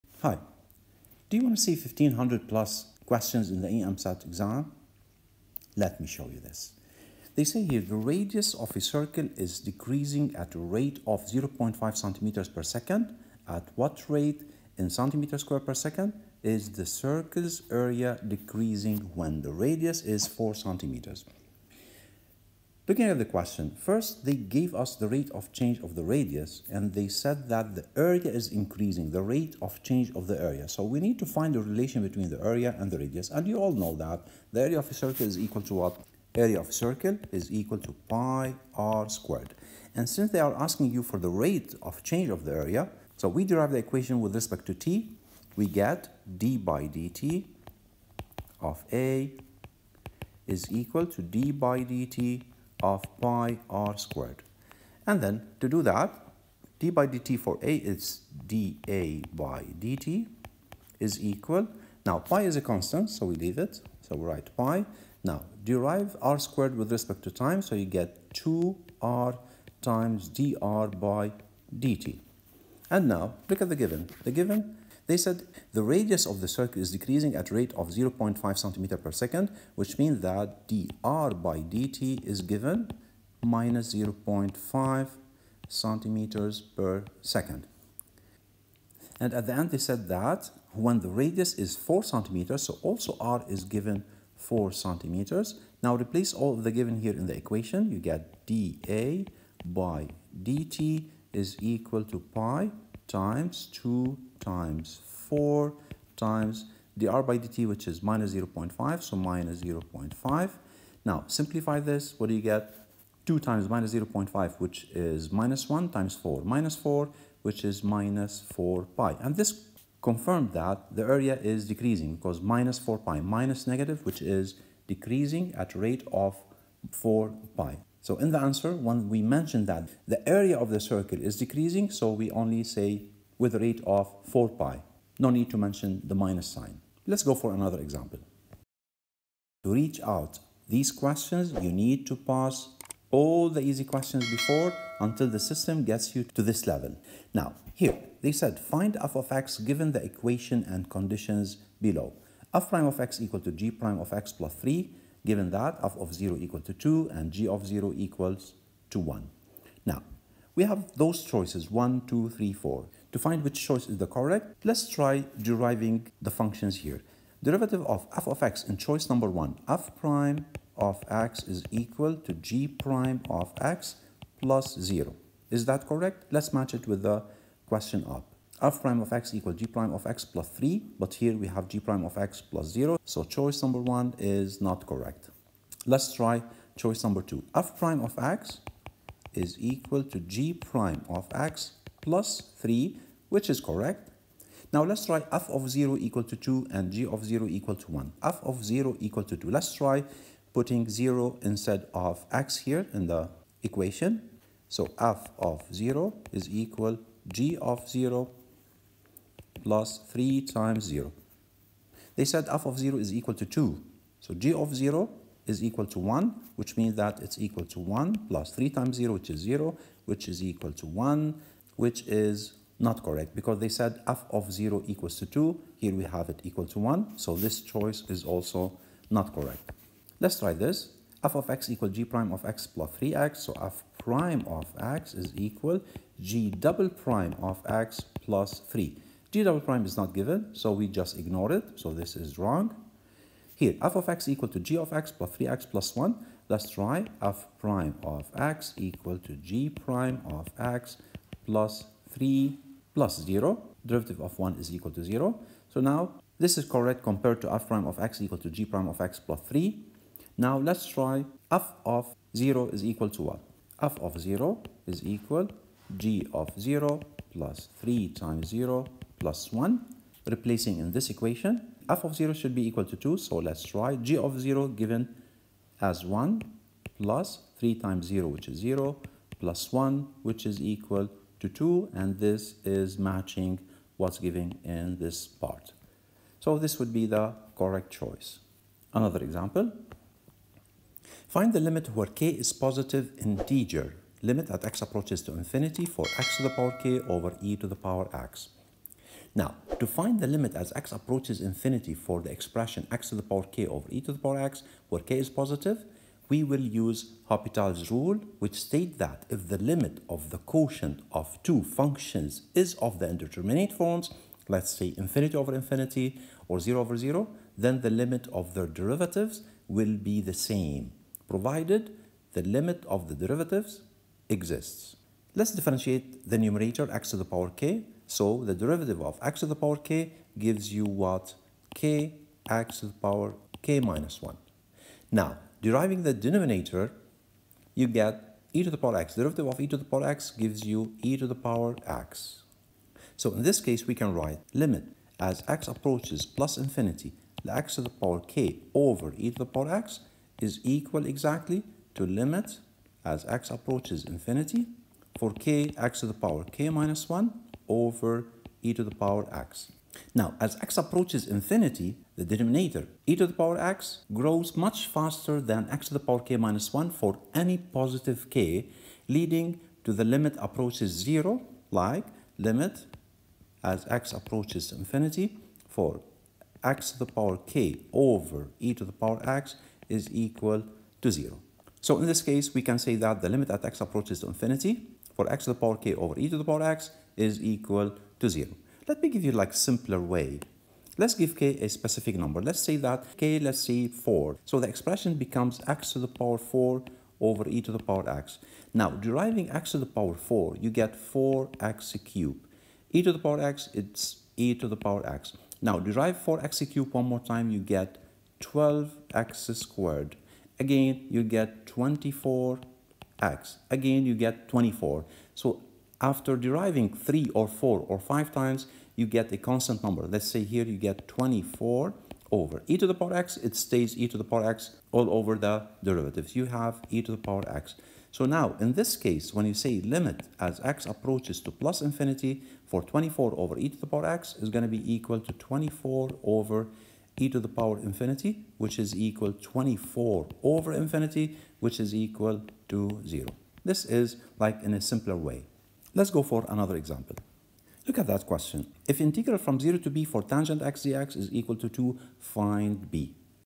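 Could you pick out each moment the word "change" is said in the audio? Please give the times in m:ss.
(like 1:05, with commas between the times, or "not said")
0:25, 0:29, 0:42.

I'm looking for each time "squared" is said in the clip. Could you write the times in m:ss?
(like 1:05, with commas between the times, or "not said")
0:15, 0:39, 0:53, 1:06, 6:49.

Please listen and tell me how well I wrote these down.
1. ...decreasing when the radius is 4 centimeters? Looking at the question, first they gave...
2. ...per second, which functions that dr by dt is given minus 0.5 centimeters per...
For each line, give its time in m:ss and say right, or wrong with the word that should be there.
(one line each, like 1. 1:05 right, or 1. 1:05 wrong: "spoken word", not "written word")
1. 0:18 right
2. 1:18 wrong: "means", not "functions".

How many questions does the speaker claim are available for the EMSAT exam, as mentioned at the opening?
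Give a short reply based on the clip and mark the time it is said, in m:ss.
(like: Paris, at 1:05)
1500 plus, at 0:01.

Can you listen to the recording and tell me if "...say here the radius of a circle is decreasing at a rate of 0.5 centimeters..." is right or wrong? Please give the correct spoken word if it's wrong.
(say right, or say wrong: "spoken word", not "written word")
right.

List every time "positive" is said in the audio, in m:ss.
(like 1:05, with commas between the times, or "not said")
4:52, 5:05, 6:07.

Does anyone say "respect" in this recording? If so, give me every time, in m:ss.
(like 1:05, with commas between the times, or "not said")
0:44, 1:06.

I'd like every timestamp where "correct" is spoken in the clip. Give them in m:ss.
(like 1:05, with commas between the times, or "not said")
2:44, 2:55, 3:04, 3:13, 3:43, 3:49, 4:16, 4:47.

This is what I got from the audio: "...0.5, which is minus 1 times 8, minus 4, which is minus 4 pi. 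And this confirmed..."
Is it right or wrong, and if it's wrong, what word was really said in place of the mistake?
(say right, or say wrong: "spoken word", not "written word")
wrong: "4", not "8".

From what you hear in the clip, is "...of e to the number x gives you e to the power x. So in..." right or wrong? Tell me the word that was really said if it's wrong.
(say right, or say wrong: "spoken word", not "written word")
wrong: "power", not "number".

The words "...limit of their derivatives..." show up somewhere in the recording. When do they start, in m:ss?
5:18.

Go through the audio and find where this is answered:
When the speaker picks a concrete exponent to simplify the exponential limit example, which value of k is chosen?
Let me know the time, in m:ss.
6:33.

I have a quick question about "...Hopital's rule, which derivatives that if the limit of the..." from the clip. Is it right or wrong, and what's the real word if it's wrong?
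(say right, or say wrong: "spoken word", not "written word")
wrong: "states", not "derivatives".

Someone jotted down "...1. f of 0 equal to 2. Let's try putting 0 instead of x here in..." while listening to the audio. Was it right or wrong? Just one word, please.
right.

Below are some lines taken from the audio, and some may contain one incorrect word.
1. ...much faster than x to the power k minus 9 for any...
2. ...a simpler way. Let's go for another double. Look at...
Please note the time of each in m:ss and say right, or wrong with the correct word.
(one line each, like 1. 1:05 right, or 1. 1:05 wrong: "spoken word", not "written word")
1. 6:04 wrong: "1", not "9"
2. 7:24 wrong: "example", not "double".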